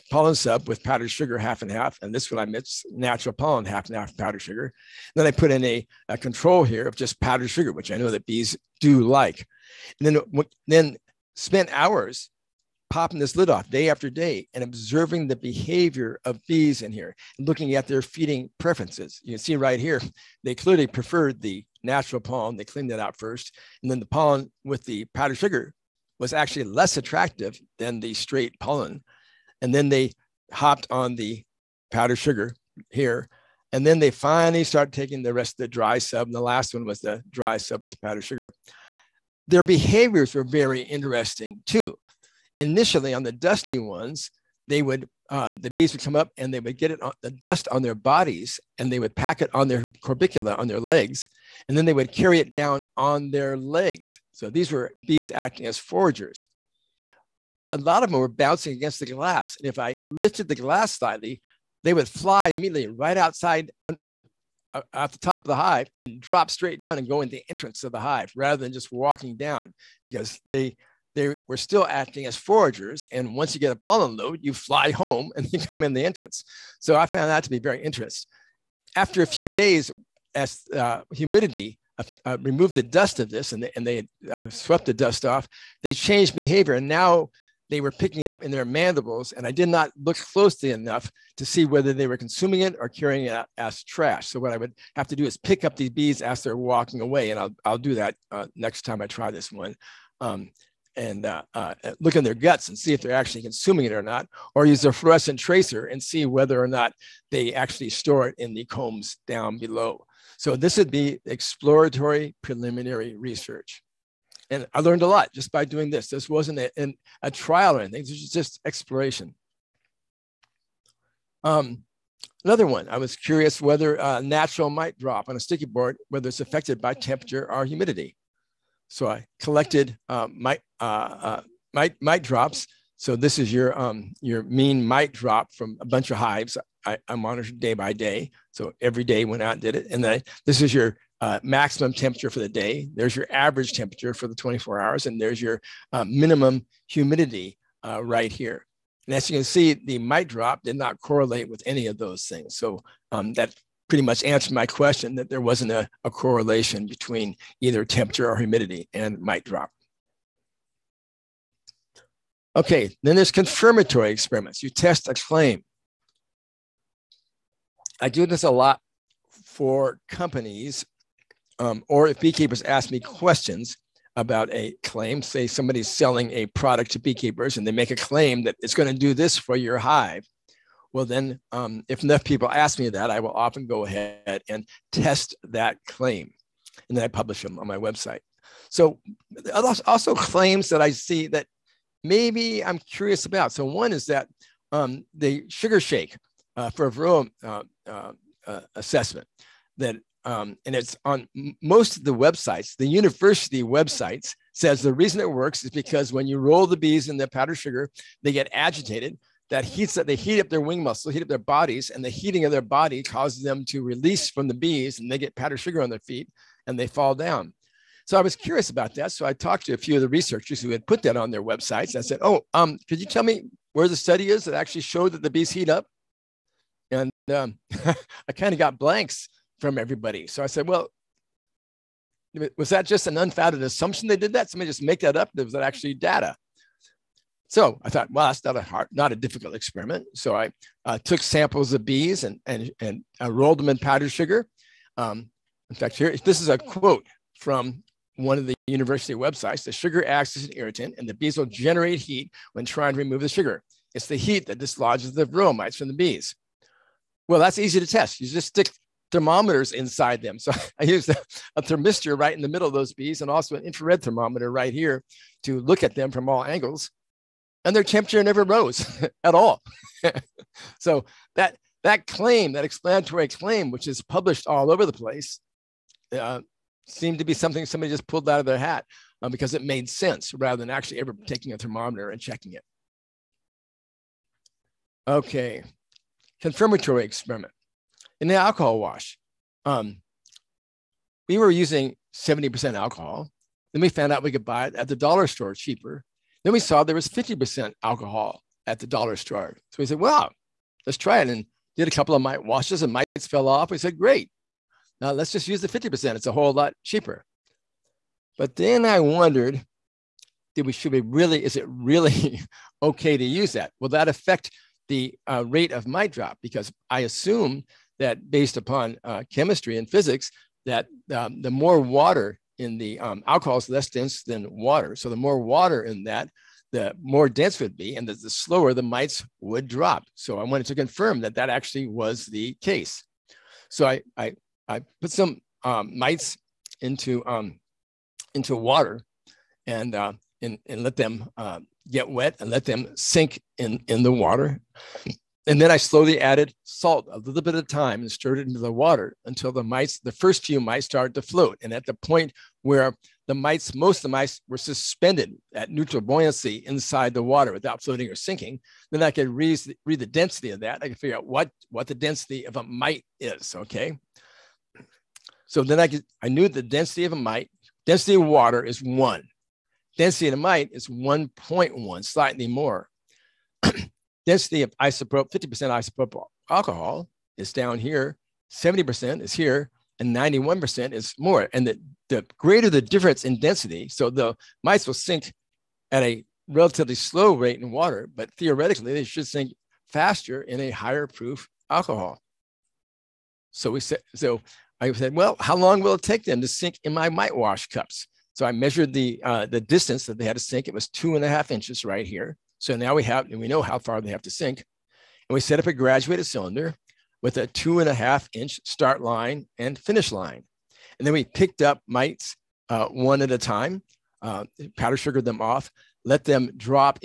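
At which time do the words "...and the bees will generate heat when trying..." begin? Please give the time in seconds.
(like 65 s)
250 s.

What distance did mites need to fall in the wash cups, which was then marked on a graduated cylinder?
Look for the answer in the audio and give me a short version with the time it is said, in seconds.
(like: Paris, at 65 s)
2.5 inches, at 400 s.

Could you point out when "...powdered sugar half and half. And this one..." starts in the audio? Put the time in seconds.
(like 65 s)
0 s.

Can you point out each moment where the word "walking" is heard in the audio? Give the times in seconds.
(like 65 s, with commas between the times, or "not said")
68 s, 96 s.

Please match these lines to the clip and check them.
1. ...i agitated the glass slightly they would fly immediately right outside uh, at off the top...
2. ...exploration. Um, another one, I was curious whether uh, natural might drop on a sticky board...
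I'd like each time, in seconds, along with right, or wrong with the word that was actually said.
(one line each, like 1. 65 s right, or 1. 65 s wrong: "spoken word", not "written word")
1. 59 s wrong: "lifted", not "agitated"
2. 118 s right.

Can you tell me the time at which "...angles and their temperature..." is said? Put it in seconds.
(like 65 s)
266 s.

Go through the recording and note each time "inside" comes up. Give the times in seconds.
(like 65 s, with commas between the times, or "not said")
259 s, 356 s.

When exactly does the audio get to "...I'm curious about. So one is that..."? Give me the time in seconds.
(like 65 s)
192 s.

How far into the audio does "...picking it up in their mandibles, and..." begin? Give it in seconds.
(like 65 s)
87 s.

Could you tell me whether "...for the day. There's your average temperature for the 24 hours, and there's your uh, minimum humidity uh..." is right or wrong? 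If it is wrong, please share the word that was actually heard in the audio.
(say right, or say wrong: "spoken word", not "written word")
right.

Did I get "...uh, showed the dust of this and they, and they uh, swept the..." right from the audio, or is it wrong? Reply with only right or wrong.
wrong.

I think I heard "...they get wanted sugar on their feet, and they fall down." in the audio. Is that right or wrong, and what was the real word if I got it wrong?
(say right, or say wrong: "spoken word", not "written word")
wrong: "powdered", not "wanted".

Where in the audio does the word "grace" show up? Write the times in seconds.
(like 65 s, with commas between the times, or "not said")
not said.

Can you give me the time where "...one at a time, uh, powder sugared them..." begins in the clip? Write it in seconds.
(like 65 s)
412 s.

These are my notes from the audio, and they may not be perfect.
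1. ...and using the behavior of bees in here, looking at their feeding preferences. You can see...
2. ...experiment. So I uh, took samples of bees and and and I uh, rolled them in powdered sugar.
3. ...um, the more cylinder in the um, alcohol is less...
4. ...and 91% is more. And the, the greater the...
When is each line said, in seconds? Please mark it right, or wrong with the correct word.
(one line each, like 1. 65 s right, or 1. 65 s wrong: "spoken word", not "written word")
1. 14 s wrong: "observing", not "using"
2. 239 s right
3. 321 s wrong: "water", not "cylinder"
4. 379 s right.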